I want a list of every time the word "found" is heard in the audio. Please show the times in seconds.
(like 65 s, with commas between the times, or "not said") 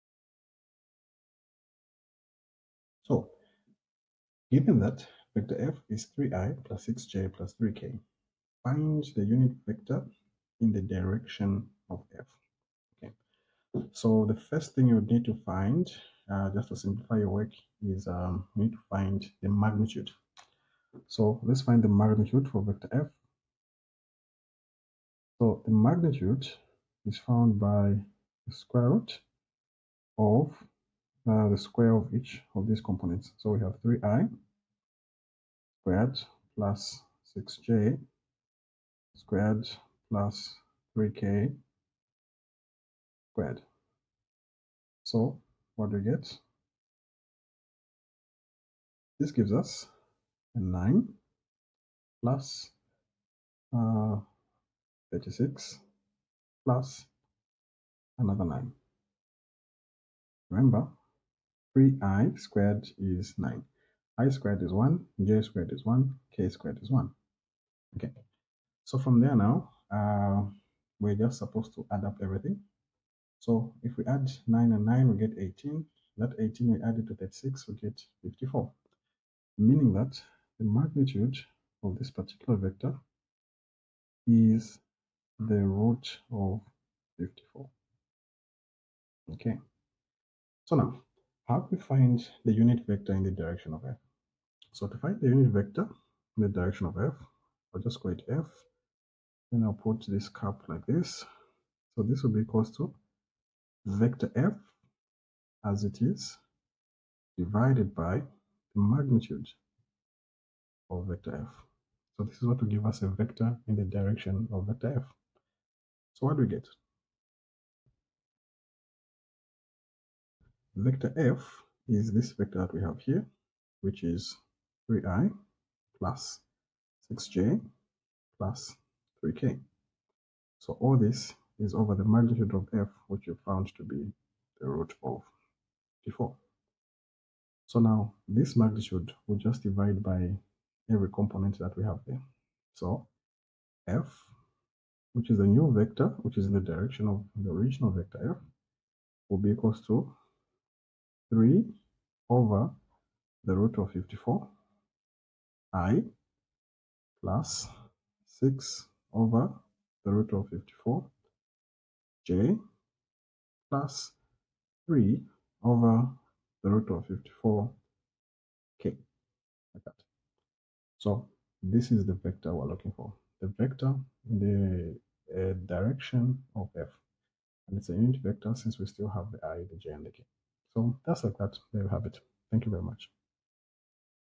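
27 s, 133 s.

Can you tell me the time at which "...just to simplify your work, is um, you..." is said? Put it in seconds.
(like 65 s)
16 s.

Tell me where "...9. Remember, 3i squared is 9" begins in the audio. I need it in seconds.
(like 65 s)
58 s.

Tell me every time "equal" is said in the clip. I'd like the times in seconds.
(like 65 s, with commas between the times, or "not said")
102 s, 149 s.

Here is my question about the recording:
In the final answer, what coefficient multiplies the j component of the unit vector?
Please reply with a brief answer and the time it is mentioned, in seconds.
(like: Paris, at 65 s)
6 over root 54, at 158 s.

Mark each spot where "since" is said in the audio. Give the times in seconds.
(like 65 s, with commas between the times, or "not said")
178 s.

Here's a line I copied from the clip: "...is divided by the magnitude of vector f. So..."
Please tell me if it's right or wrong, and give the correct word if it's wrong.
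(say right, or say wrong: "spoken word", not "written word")
right.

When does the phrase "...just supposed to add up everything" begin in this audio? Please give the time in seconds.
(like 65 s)
71 s.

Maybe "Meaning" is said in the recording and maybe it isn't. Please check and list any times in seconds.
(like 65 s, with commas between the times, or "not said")
79 s.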